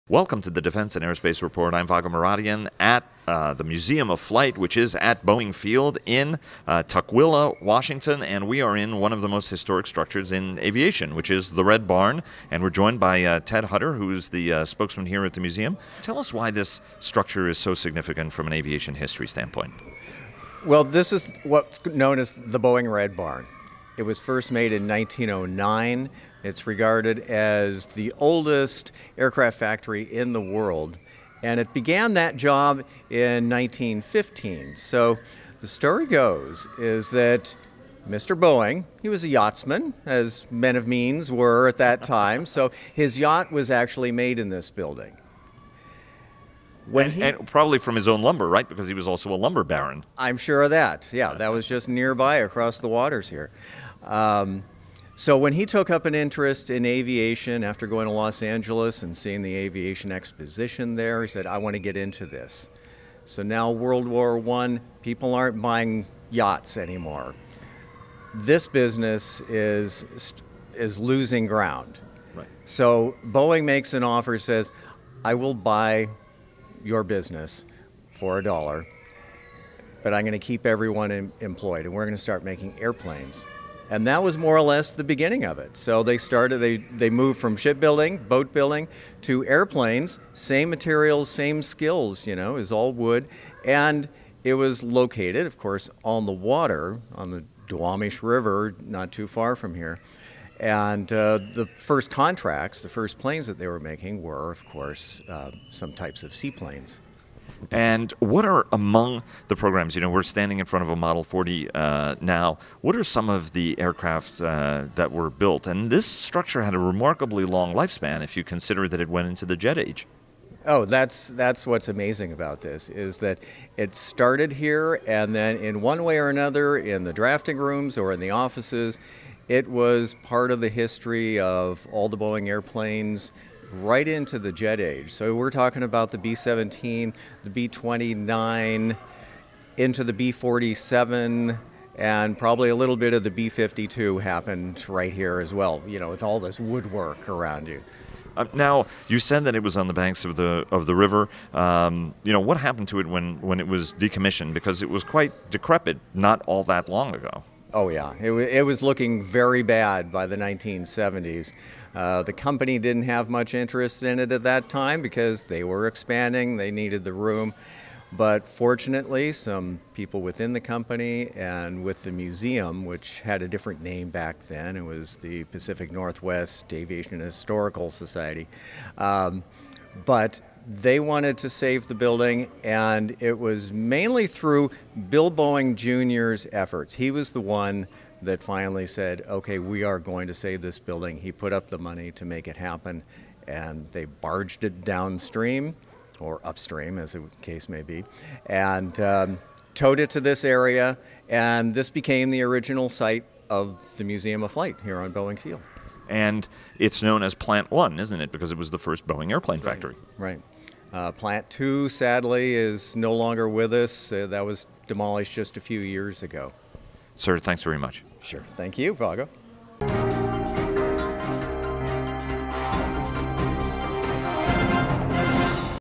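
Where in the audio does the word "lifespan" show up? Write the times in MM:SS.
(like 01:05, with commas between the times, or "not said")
01:57.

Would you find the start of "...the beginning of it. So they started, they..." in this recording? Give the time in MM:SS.
01:24.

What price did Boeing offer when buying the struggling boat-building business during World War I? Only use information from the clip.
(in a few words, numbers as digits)
a dollar.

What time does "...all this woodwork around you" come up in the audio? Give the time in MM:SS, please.
02:26.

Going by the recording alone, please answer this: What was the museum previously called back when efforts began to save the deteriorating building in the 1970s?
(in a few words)
Pacific Northwest Aviation Historical Society.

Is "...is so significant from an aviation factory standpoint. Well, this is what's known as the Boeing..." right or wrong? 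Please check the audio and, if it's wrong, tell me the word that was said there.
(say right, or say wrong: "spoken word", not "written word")
wrong: "history", not "factory".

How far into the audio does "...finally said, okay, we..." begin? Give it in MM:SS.
03:08.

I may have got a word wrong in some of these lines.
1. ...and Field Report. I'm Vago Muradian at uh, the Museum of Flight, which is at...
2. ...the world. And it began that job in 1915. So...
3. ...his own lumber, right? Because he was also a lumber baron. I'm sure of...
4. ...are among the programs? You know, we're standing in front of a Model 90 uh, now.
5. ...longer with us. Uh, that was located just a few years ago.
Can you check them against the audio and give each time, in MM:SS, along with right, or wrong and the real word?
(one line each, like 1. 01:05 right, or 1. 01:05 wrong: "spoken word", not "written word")
1. 00:00 wrong: "Aerospace", not "Field"
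2. 00:30 right
3. 00:47 right
4. 01:48 wrong: "40", not "90"
5. 03:33 wrong: "demolished", not "located".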